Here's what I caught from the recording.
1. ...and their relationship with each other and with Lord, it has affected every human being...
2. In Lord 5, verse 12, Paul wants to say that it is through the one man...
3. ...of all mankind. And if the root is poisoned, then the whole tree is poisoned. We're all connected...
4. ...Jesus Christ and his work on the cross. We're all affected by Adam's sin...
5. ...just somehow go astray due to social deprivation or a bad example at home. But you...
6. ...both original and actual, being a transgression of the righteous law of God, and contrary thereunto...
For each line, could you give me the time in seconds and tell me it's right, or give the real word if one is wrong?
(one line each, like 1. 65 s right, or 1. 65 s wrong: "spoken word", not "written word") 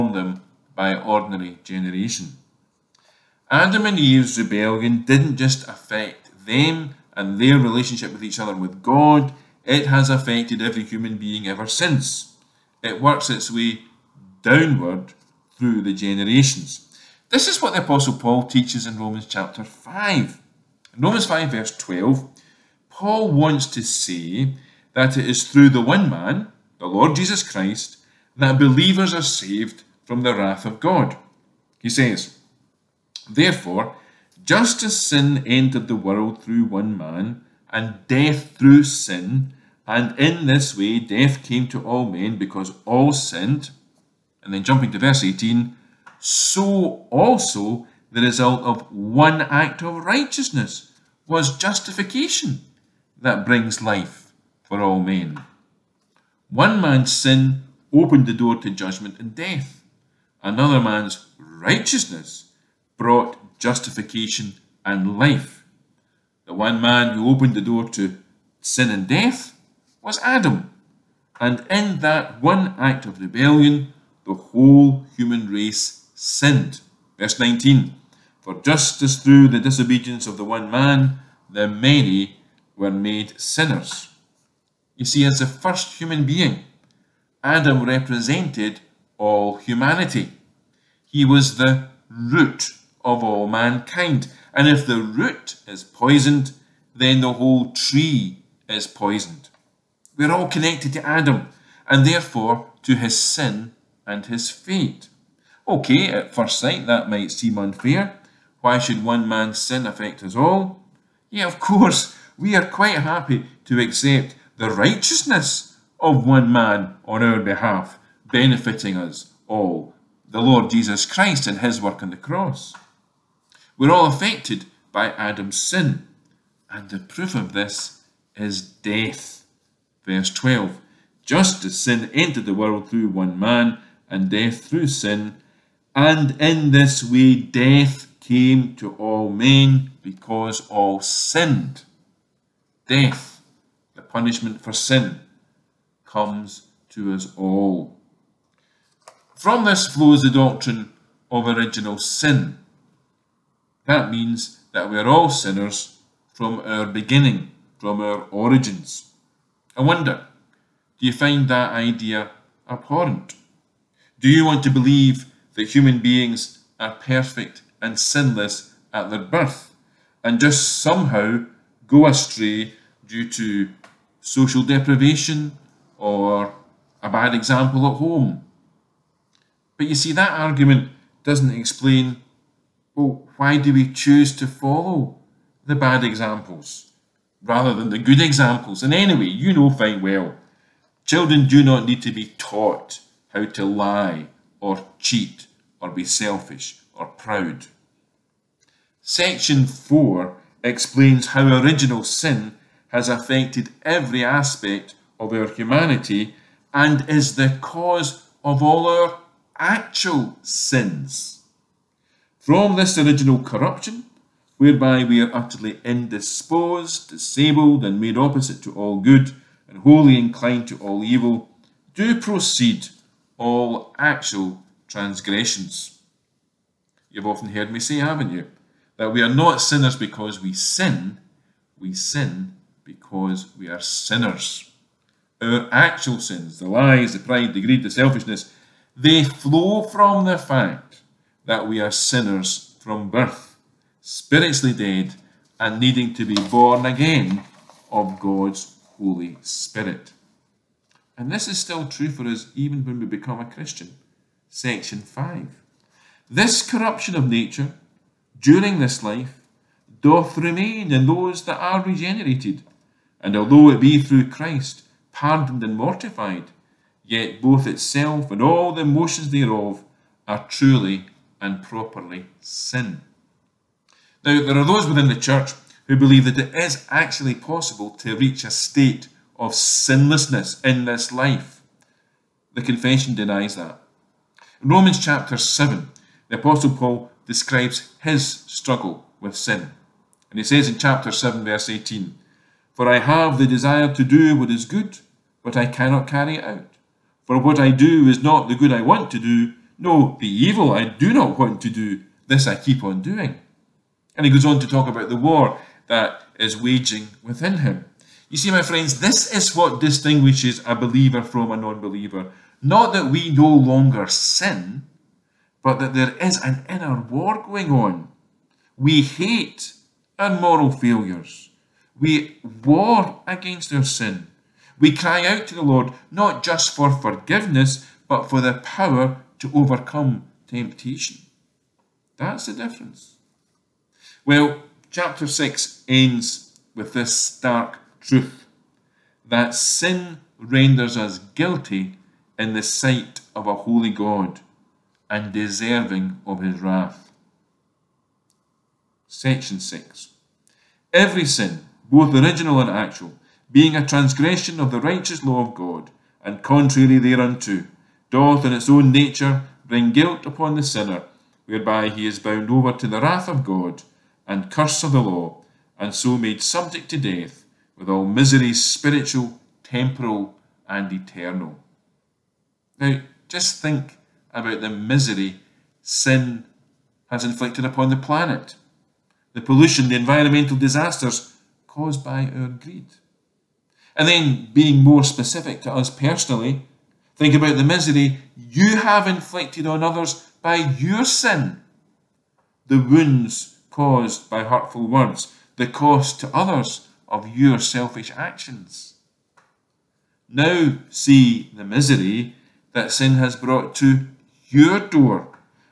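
1. 7 s wrong: "God", not "Lord"
2. 20 s wrong: "Romans", not "Lord"
3. 93 s right
4. 120 s right
5. 170 s right
6. 351 s right.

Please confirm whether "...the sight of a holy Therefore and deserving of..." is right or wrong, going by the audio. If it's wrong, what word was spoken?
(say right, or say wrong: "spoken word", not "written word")
wrong: "God", not "Therefore".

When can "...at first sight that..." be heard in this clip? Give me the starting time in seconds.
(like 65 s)
106 s.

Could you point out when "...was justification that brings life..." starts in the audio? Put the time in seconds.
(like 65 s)
51 s.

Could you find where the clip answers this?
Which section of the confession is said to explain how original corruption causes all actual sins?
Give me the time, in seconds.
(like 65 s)
199 s.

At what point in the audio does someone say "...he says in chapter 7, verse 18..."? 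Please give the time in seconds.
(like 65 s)
290 s.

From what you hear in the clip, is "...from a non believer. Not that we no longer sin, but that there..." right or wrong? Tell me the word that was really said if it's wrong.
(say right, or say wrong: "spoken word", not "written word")
right.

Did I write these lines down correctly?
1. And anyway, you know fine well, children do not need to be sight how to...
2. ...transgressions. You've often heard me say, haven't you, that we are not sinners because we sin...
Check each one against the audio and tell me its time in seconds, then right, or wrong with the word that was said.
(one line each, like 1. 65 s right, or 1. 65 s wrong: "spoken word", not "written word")
1. 188 s wrong: "taught", not "sight"
2. 224 s right.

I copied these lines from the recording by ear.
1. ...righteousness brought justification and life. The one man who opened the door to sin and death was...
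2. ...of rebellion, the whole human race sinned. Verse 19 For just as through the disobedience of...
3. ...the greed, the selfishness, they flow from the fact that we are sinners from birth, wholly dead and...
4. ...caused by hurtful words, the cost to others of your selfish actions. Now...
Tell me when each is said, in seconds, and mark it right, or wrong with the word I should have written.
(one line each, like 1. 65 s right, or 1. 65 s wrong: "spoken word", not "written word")
1. 61 s right
2. 73 s right
3. 237 s wrong: "spiritually", not "wholly"
4. 393 s right.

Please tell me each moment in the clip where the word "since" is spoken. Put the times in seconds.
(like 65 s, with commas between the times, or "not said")
11 s.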